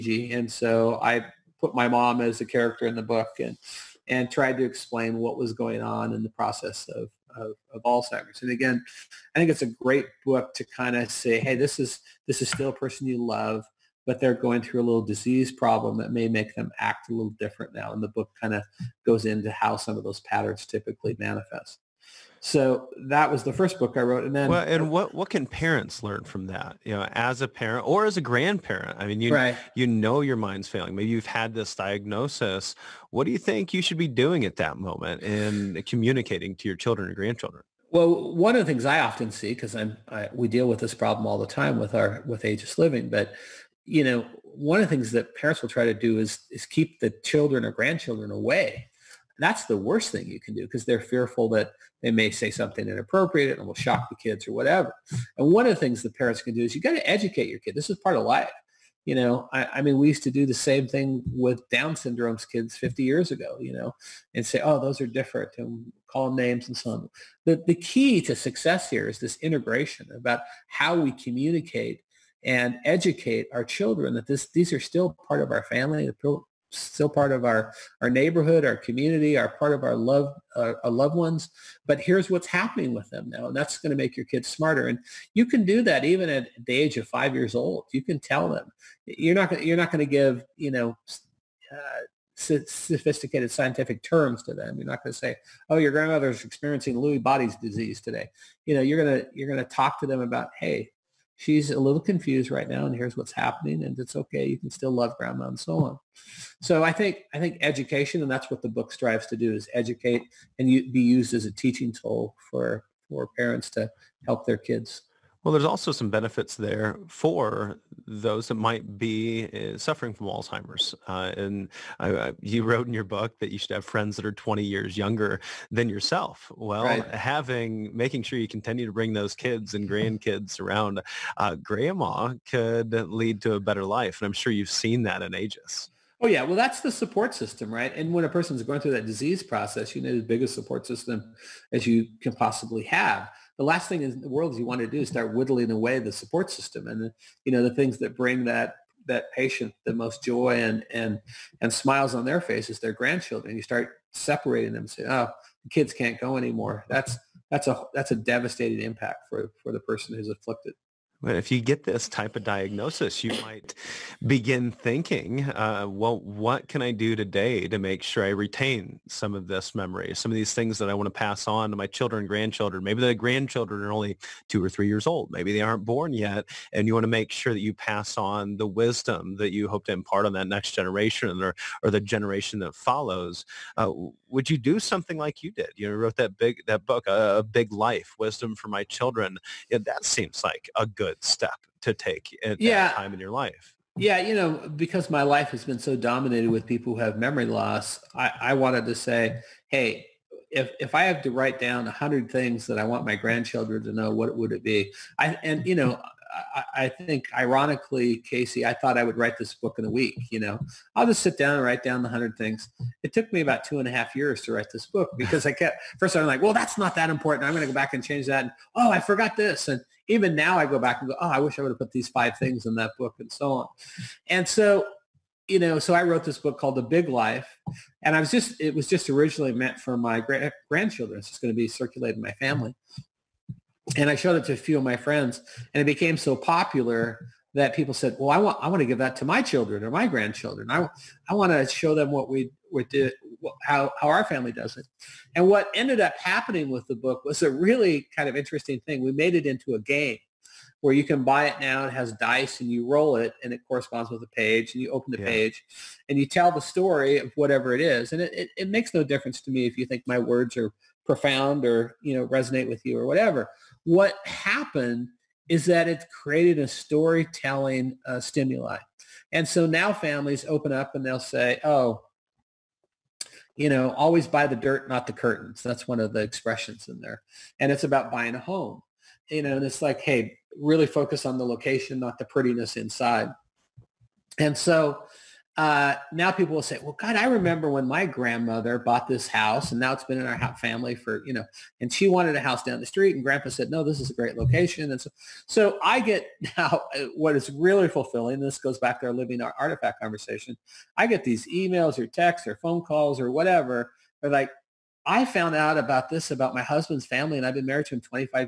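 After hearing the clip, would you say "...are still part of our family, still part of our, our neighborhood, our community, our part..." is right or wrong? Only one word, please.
right.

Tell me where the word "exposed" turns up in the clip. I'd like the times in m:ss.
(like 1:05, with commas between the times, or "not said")
not said.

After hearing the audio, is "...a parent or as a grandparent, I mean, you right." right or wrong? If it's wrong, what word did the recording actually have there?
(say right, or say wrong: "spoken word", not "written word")
right.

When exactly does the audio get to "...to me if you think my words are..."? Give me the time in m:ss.
4:19.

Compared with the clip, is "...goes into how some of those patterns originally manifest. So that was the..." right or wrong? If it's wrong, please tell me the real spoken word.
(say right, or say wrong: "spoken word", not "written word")
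wrong: "typically", not "originally".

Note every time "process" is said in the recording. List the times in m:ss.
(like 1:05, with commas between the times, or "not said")
0:06, 2:19.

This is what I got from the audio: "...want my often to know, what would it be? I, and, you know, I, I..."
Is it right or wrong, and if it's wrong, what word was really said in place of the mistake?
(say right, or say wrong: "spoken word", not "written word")
wrong: "grandchildren", not "often".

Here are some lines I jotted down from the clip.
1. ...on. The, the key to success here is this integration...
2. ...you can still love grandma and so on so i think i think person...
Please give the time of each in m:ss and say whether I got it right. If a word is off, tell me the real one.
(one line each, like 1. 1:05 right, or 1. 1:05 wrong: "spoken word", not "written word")
1. 1:06 right
2. 1:44 wrong: "education", not "person".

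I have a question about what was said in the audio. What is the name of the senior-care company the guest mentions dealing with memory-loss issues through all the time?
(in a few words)
Aegis Living.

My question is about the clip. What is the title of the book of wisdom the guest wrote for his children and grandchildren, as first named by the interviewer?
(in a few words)
A Big Life.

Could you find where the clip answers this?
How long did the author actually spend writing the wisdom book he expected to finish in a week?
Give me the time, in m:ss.
3:33.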